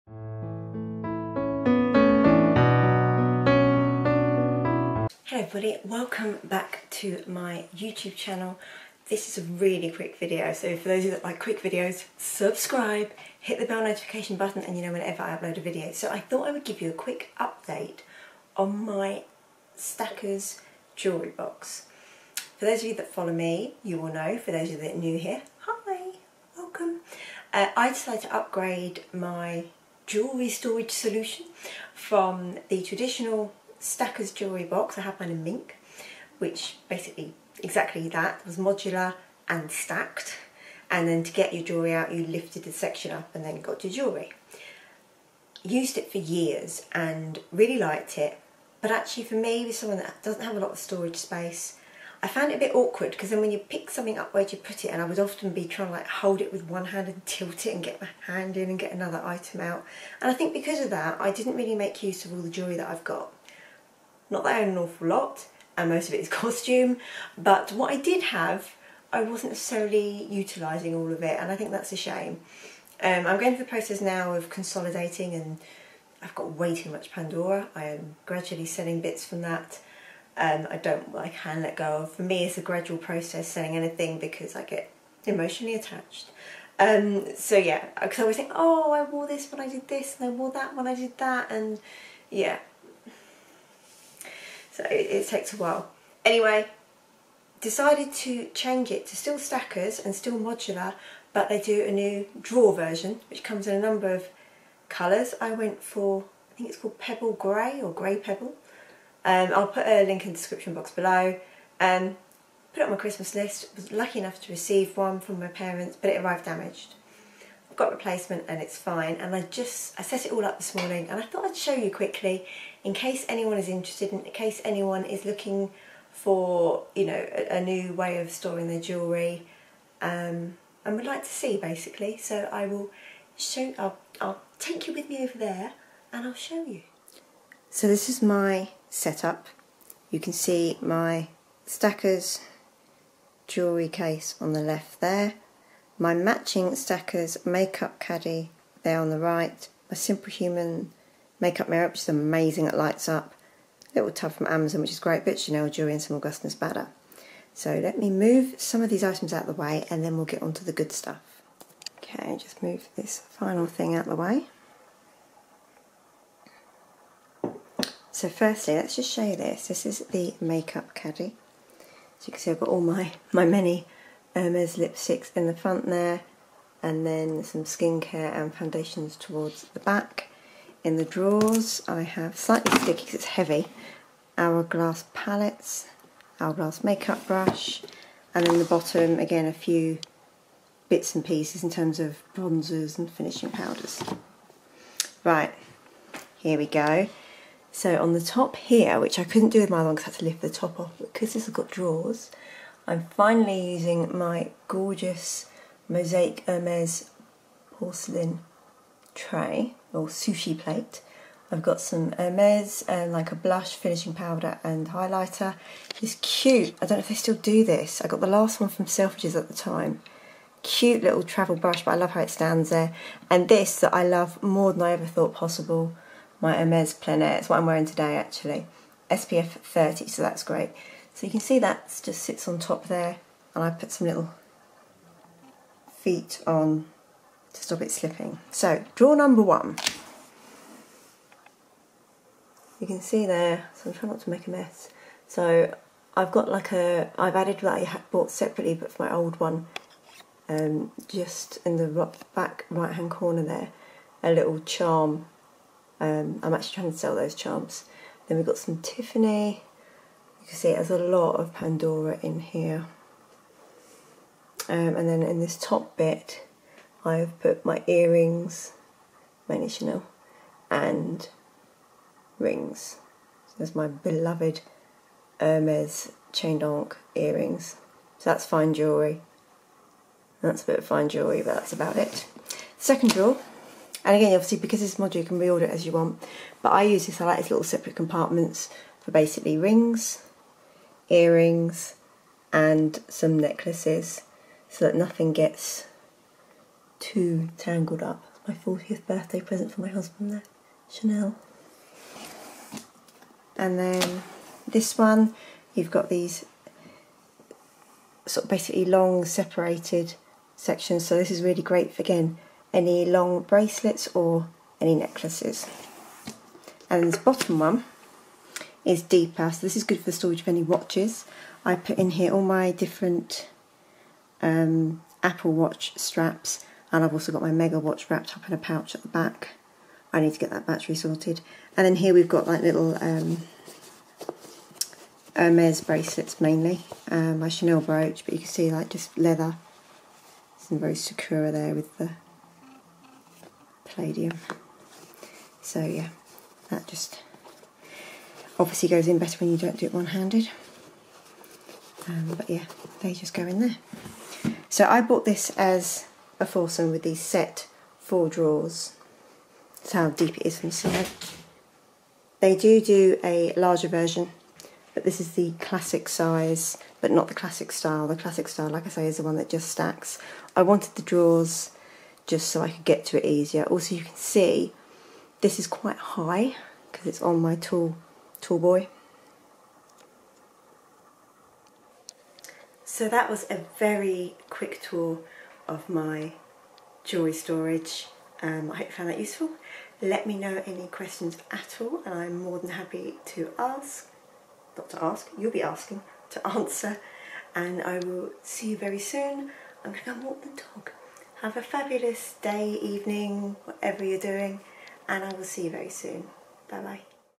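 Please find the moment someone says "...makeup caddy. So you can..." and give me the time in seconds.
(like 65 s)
170 s.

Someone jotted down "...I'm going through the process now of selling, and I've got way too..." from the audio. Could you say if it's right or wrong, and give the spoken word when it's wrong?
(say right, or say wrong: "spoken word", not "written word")
wrong: "consolidating", not "selling".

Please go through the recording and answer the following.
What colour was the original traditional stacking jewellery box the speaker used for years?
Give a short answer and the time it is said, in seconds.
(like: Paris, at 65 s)
Mink, at 35 s.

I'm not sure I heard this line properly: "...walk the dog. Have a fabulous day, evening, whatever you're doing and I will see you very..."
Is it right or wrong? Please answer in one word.
right.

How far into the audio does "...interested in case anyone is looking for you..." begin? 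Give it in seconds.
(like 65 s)
123 s.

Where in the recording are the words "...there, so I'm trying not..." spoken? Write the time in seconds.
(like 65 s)
243 s.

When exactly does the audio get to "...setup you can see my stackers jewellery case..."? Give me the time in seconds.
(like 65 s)
138 s.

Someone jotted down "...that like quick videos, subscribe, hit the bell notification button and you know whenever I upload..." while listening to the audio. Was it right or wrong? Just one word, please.
right.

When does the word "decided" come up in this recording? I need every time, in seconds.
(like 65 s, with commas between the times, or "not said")
27 s, 97 s.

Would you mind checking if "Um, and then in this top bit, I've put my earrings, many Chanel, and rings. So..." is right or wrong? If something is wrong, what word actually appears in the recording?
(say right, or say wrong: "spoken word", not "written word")
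right.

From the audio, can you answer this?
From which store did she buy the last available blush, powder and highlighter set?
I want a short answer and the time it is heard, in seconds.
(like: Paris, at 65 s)
Selfridges, at 218 s.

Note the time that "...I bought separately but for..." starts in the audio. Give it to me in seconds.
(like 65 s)
247 s.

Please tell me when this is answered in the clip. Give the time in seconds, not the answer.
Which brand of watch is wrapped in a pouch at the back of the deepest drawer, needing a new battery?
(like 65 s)
327 s.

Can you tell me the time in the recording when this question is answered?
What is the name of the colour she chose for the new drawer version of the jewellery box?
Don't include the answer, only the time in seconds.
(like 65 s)
106 s.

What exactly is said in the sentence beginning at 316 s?
And this bottom one is deeper.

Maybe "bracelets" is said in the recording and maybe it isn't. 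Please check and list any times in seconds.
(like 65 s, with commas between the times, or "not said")
313 s, 335 s.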